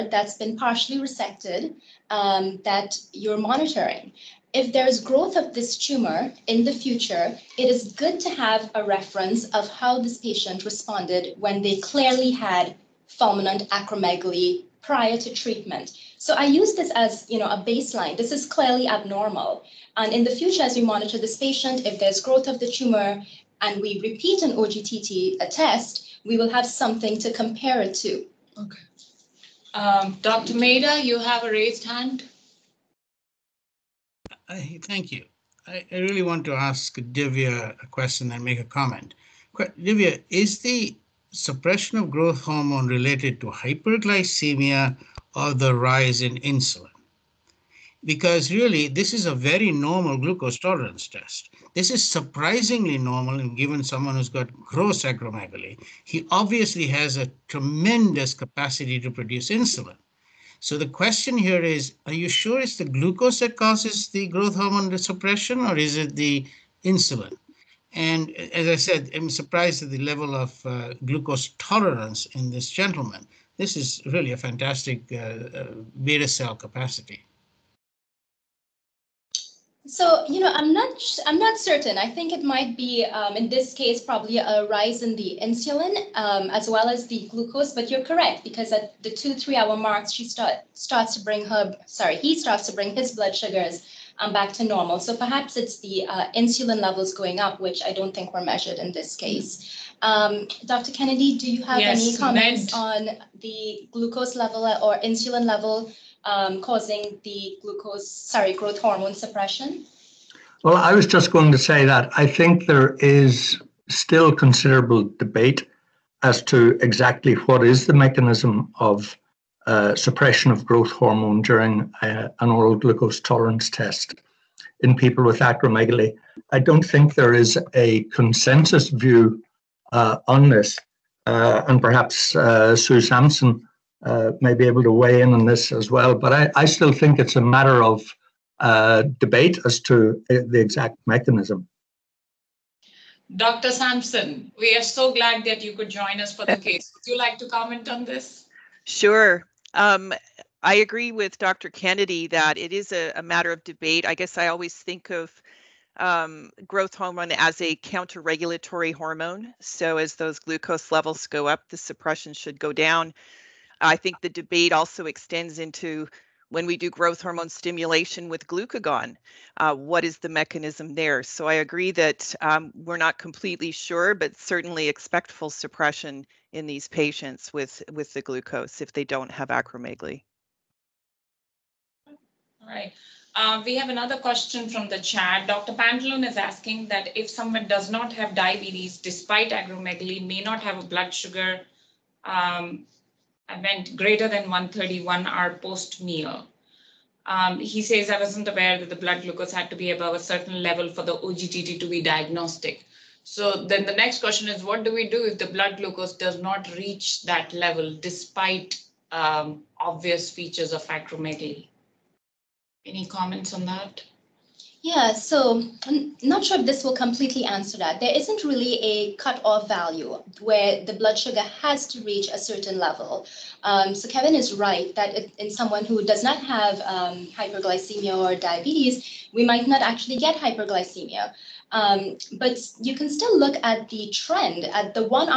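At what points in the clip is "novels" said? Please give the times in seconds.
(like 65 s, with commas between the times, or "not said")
not said.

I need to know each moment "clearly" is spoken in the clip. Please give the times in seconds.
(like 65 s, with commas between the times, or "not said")
11 s, 18 s.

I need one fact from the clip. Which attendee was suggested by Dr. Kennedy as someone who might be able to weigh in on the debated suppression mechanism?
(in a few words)
Sue Samson.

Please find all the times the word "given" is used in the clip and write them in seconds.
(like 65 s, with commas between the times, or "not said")
53 s.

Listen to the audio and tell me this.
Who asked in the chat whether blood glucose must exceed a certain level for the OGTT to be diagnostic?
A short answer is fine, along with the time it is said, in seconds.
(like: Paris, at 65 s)
Dr. Pantalone, at 185 s.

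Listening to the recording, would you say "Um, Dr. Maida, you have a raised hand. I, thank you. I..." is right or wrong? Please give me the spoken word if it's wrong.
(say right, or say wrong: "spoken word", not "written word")
right.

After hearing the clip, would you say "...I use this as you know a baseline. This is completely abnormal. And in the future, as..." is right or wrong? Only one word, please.
wrong.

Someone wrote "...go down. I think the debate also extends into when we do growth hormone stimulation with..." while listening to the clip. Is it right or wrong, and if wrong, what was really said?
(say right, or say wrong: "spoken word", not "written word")
right.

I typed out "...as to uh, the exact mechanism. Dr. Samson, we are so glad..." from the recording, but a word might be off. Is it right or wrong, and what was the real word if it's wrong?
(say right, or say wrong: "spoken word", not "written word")
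right.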